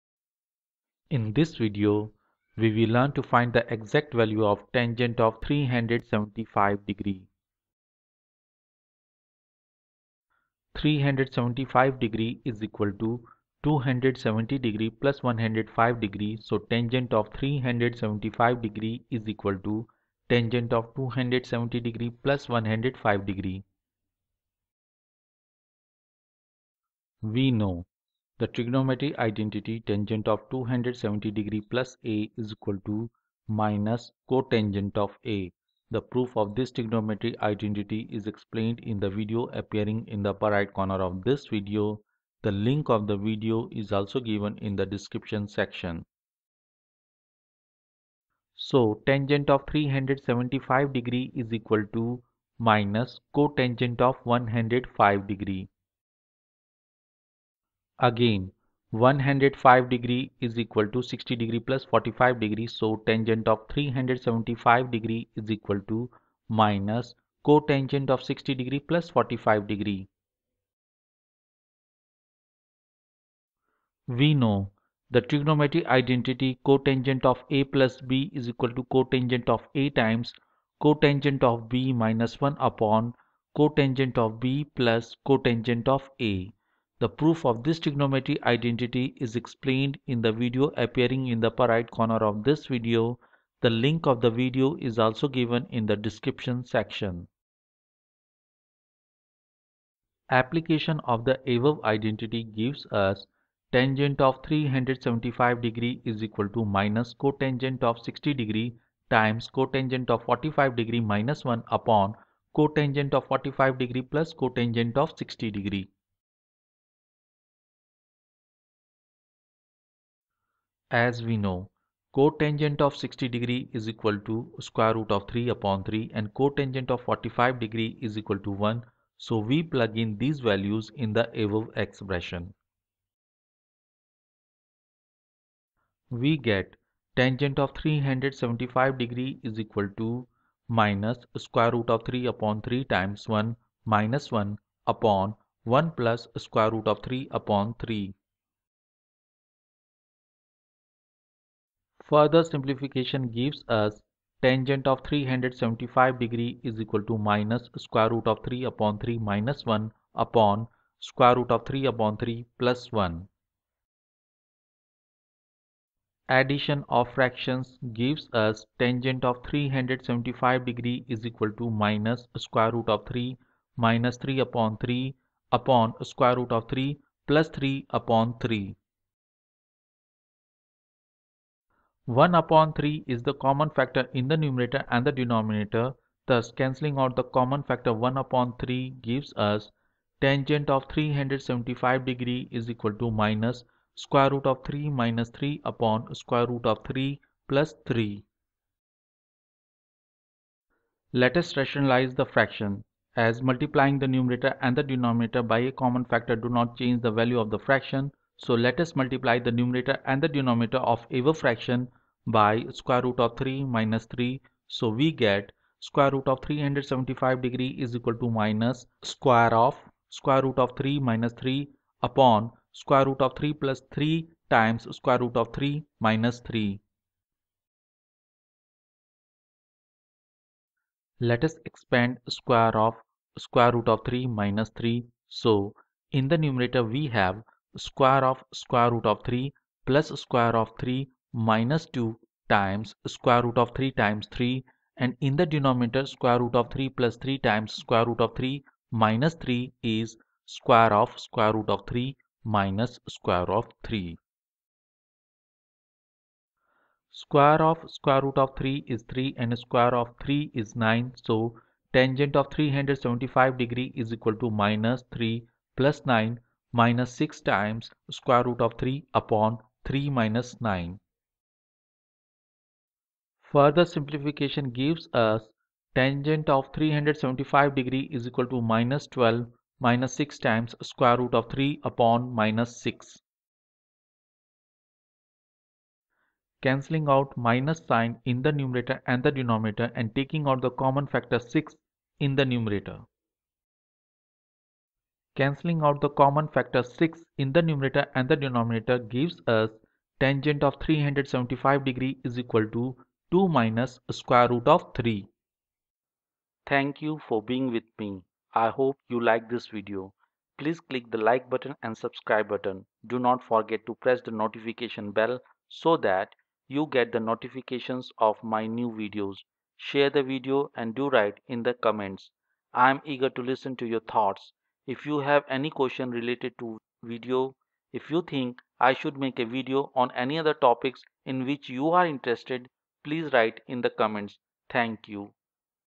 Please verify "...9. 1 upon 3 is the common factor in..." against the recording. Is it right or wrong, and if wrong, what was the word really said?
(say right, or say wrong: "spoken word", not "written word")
wrong: "3", not "9".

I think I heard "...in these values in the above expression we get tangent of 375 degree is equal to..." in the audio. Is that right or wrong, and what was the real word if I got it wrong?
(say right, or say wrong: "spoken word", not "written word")
right.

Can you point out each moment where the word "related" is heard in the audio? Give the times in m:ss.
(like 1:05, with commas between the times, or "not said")
5:26.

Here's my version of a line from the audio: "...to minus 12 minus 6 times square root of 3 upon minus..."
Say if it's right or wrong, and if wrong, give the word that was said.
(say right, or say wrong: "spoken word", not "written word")
right.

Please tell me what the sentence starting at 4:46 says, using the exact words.
Cancelling out minus sign in the numerator and the denominator and taking out the common factor 6 in the numerator.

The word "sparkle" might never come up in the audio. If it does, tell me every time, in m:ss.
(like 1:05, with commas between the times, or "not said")
not said.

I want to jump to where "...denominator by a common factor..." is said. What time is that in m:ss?
3:24.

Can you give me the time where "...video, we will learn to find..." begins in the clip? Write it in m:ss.
0:01.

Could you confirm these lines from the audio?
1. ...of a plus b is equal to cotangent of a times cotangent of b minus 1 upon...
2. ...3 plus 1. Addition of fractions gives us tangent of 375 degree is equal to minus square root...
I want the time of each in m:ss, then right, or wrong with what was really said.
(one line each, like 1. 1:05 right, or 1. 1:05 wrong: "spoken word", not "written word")
1. 1:17 right
2. 2:42 right.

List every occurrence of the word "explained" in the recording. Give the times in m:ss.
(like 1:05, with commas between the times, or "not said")
0:38, 1:29.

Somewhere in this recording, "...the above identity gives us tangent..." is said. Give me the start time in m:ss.
1:41.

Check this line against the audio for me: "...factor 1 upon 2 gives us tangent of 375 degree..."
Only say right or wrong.
wrong.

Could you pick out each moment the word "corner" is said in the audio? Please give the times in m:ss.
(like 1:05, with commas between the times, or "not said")
0:40, 1:31.